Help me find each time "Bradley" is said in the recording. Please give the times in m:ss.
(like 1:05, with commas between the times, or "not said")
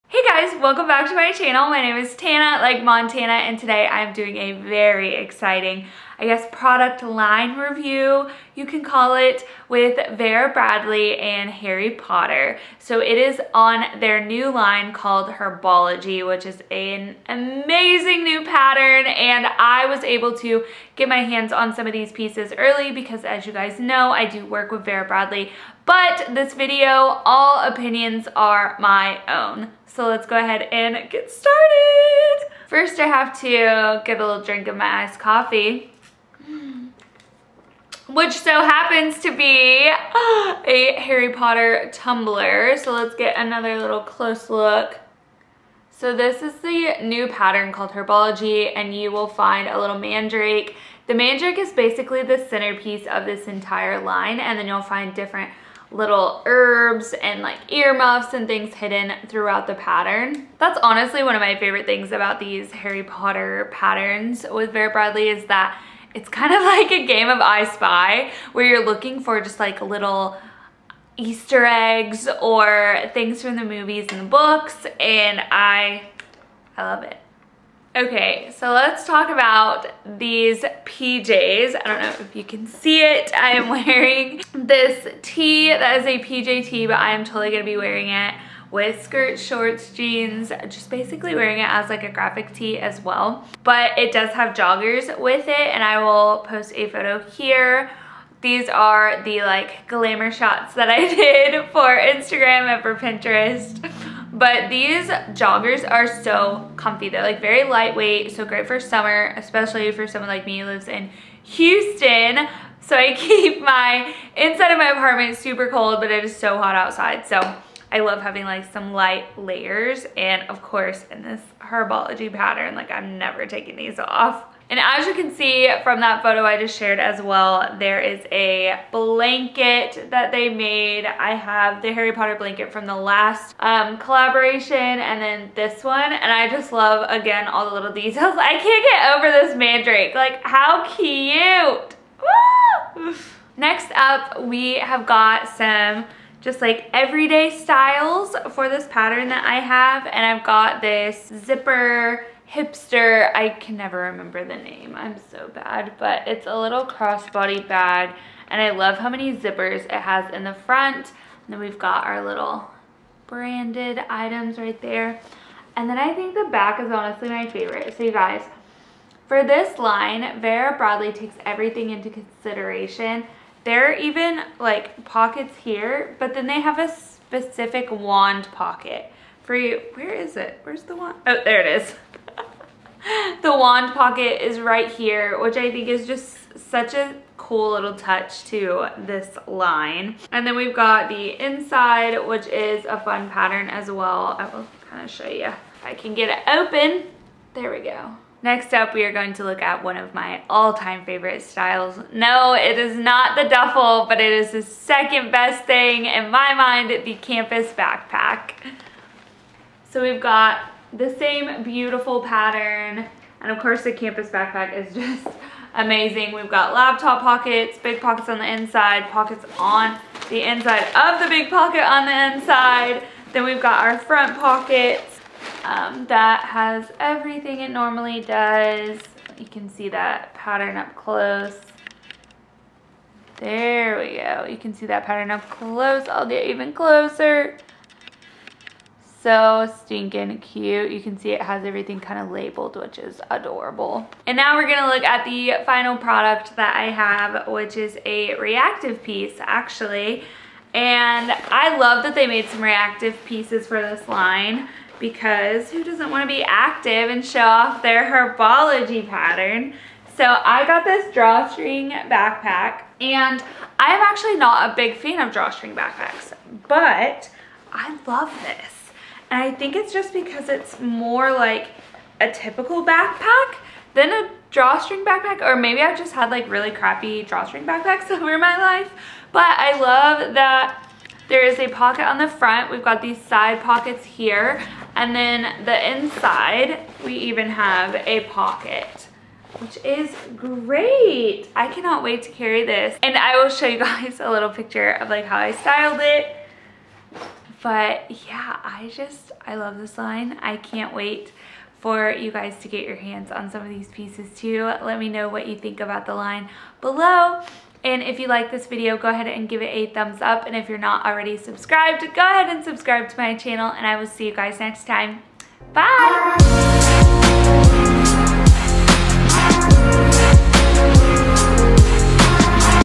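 0:10, 0:25, 1:04, 2:50.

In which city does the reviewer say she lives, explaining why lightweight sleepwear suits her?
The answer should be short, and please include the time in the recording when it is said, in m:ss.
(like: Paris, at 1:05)
Houston, at 1:51.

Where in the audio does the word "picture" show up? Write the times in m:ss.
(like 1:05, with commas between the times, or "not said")
4:54.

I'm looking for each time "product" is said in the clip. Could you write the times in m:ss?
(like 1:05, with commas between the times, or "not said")
0:06, 4:05.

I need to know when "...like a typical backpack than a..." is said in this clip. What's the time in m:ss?
4:31.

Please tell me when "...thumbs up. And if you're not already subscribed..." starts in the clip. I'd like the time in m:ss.
5:09.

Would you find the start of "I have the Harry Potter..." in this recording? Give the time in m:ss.
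2:11.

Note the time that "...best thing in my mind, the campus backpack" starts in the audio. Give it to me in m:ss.
3:25.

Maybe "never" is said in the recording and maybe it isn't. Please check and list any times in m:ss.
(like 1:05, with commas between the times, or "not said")
2:03, 2:33.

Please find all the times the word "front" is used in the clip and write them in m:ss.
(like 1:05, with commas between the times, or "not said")
2:40, 3:43, 4:42.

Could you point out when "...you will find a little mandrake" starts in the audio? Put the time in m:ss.
0:48.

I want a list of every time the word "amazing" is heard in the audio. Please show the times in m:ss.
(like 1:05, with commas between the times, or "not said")
0:17, 3:35.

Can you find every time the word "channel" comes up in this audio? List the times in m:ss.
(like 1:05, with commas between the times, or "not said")
0:01, 5:13.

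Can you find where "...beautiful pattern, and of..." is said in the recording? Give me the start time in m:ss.
3:31.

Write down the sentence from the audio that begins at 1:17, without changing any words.
Okay, so let's talk about these PJs.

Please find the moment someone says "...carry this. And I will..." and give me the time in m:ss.
4:52.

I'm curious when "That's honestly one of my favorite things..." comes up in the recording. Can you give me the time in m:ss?
1:00.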